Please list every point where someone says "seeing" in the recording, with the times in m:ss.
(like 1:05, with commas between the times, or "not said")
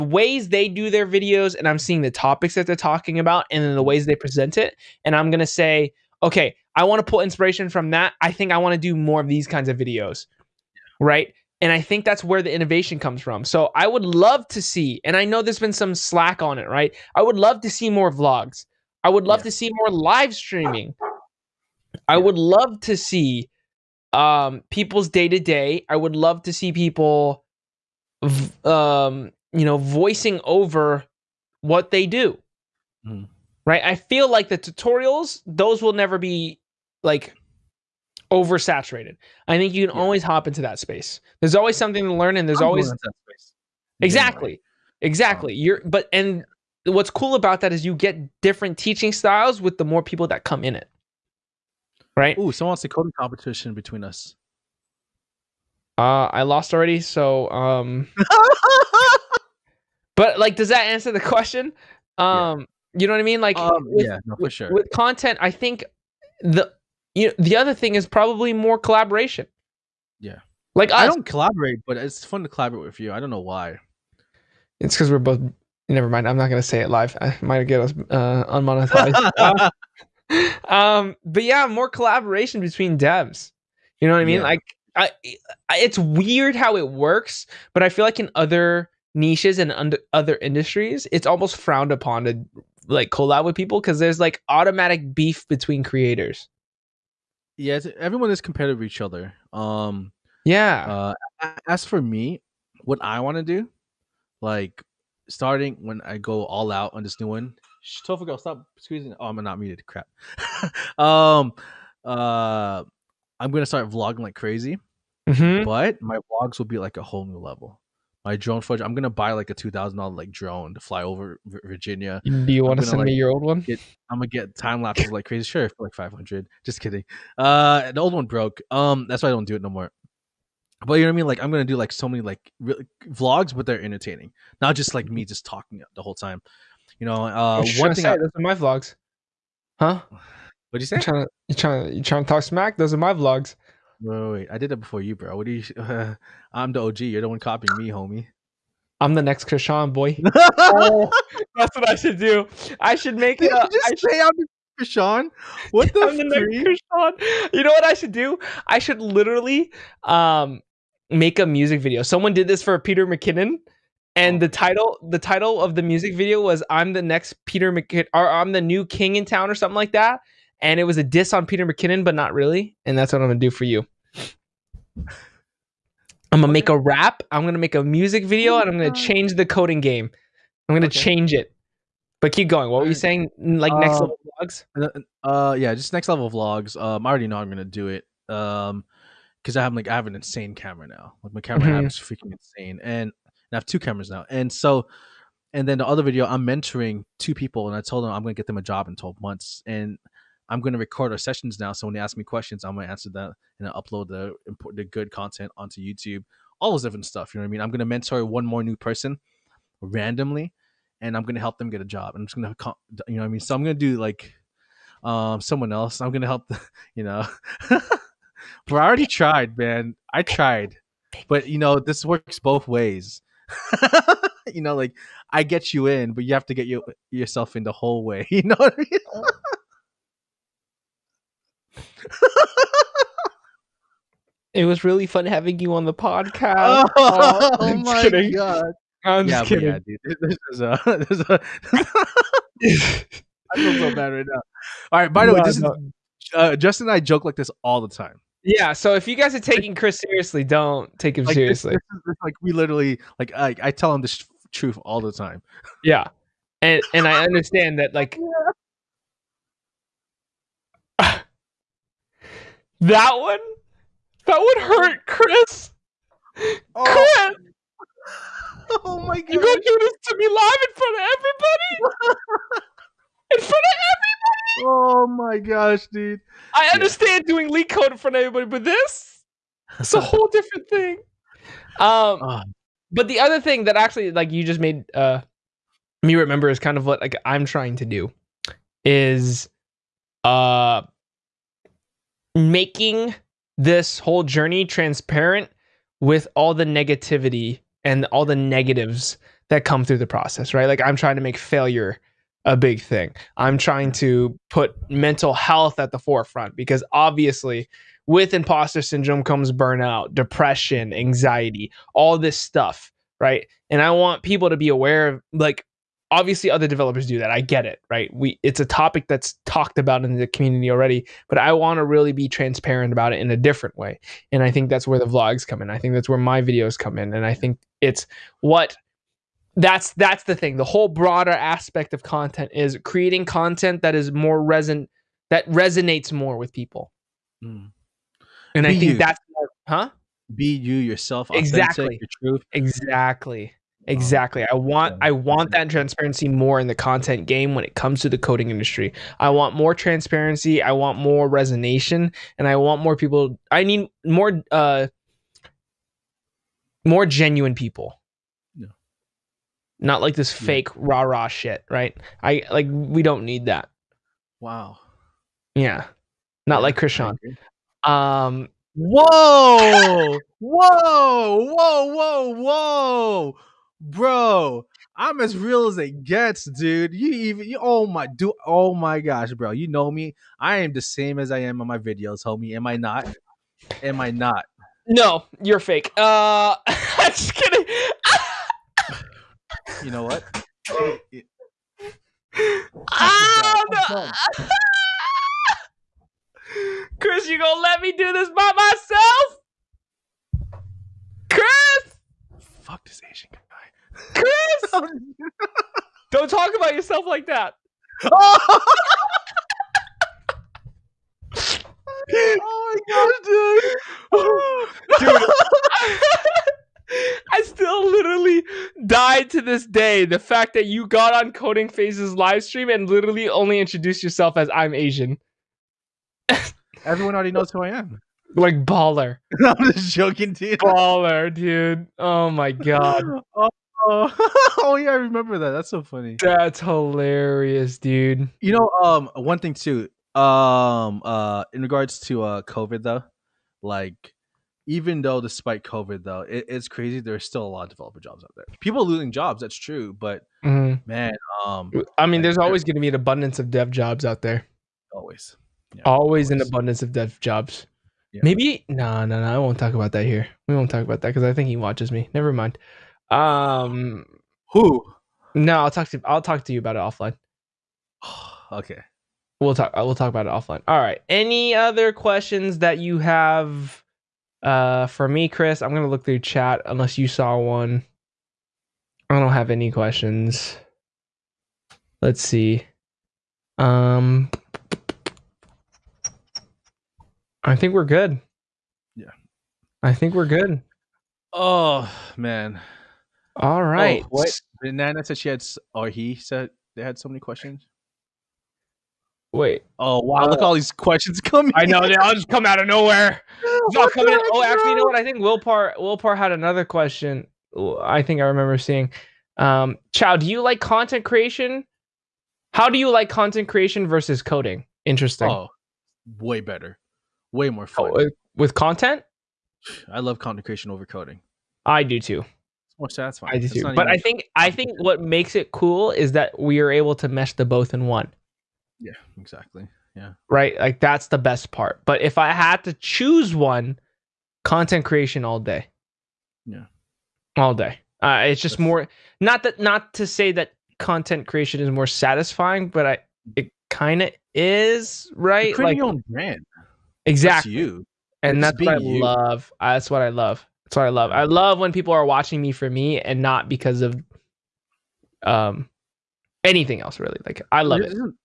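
0:01, 8:28.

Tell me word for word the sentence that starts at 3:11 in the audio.
app is freaking insane, and, and I have two cameras now.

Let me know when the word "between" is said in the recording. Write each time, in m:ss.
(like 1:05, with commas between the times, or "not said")
0:53, 1:22, 1:35.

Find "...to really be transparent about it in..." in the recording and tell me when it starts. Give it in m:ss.
5:21.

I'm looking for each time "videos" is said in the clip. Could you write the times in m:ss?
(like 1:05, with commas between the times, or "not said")
0:01, 0:09, 2:41, 2:46, 2:58, 3:16, 5:26, 6:21.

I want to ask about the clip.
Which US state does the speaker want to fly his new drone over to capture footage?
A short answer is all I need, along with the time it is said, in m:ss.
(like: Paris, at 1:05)
Virginia, at 2:01.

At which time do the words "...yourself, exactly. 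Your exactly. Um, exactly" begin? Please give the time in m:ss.
5:40.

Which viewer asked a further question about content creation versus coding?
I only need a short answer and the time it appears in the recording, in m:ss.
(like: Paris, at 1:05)
Will Part, at 8:25.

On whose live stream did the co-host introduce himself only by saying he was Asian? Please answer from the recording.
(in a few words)
Coding Phase.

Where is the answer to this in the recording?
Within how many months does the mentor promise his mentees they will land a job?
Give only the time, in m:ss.
3:18.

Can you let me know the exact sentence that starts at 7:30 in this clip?
man, um, I mean, there's always going to be an abundance of dev jobs out there.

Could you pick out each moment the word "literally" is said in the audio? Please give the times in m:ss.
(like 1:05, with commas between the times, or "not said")
2:39, 4:12, 6:57, 7:02.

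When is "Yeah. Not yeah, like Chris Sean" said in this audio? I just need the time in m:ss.
6:05.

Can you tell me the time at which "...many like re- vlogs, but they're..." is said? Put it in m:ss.
2:12.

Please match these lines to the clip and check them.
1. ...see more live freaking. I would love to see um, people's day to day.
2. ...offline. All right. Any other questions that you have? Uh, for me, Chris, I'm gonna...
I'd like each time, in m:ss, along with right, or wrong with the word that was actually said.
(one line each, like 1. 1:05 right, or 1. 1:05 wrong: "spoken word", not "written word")
1. 0:19 wrong: "streaming", not "freaking"
2. 7:50 right.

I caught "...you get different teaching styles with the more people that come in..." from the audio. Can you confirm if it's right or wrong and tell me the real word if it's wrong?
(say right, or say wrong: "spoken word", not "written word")
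right.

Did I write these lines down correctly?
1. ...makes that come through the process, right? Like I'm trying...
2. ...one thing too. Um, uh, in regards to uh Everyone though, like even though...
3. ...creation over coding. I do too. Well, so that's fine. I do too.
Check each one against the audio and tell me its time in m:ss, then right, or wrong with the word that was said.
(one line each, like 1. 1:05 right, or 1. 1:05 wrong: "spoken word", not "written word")
1. 4:58 wrong: "negatives", not "makes"
2. 7:19 wrong: "COVID", not "Everyone"
3. 8:40 right.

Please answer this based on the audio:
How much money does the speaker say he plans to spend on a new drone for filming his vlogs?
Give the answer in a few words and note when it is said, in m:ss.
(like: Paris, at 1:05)
$2,000, at 1:59.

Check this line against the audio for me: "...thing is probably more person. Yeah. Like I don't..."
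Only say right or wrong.
wrong.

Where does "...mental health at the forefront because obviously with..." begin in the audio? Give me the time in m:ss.
5:04.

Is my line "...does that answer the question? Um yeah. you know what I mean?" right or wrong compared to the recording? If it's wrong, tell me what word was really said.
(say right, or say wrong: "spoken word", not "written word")
right.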